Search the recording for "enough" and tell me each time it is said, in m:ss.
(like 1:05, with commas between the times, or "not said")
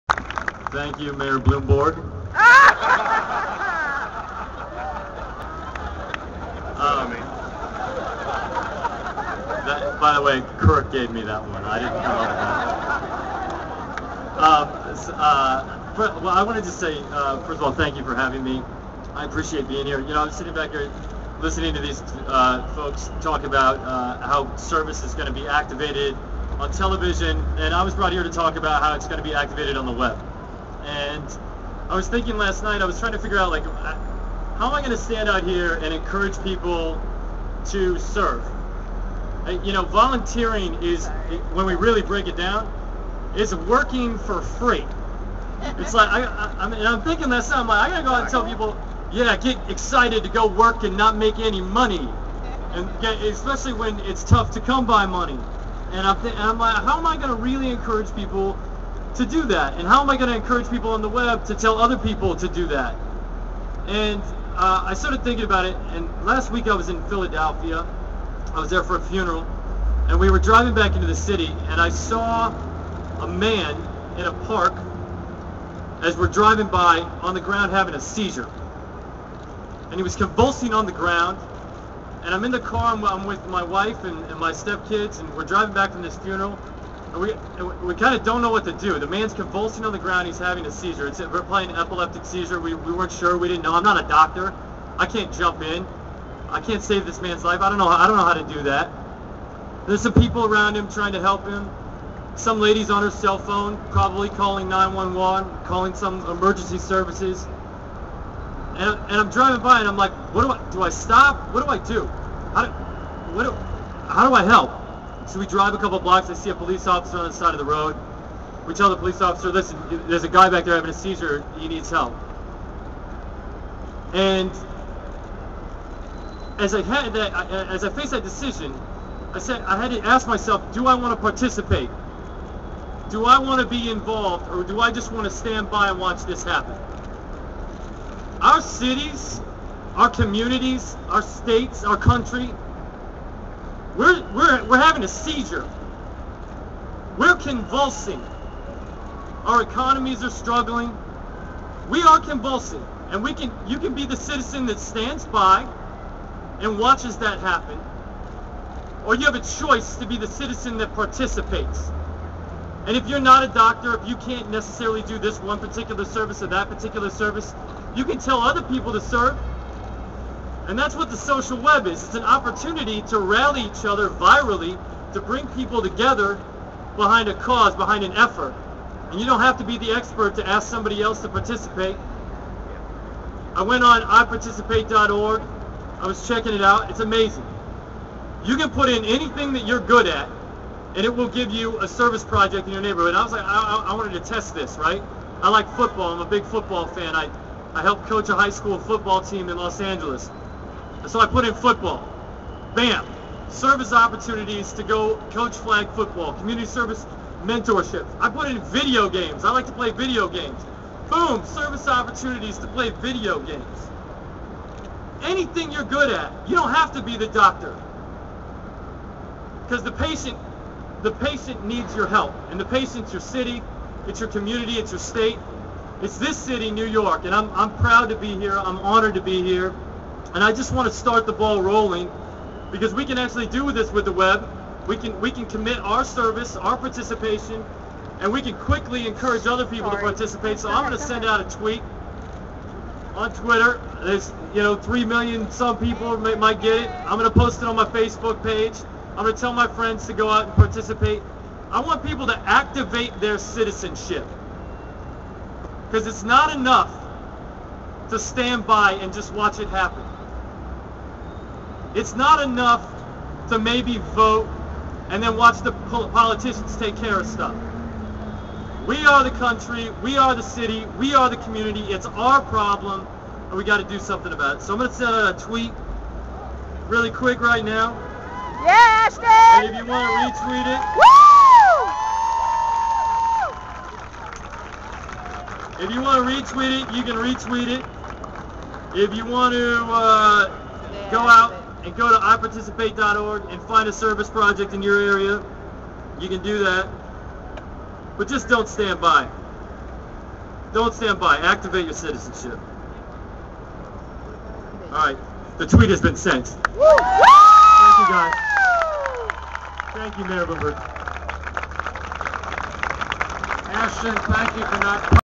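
4:16, 4:22.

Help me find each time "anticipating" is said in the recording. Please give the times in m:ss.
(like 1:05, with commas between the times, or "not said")
not said.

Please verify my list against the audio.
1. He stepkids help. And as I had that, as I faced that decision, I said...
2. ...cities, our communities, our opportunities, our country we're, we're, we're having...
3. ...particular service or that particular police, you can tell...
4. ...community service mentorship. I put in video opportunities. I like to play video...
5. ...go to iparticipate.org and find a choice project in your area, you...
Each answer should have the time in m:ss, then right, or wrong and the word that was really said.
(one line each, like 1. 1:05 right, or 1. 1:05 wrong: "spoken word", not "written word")
1. 2:01 wrong: "needs", not "stepkids"
2. 2:18 wrong: "states", not "opportunities"
3. 2:45 wrong: "service", not "police"
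4. 3:26 wrong: "games", not "opportunities"
5. 4:51 wrong: "service", not "choice".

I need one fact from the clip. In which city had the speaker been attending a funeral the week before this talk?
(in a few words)
Philadelphia.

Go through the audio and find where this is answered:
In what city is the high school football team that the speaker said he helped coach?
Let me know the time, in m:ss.
3:19.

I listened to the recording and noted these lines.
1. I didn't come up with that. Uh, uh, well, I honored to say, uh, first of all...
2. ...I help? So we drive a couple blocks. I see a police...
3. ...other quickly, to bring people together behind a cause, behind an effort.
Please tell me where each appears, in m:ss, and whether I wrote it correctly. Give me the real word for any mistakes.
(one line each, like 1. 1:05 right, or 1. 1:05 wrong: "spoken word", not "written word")
1. 0:11 wrong: "wanted", not "honored"
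2. 1:54 right
3. 2:53 wrong: "virally", not "quickly".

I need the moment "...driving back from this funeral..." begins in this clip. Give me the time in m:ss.
1:25.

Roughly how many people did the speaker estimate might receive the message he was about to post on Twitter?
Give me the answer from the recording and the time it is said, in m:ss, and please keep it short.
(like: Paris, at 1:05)
3 million, at 4:04.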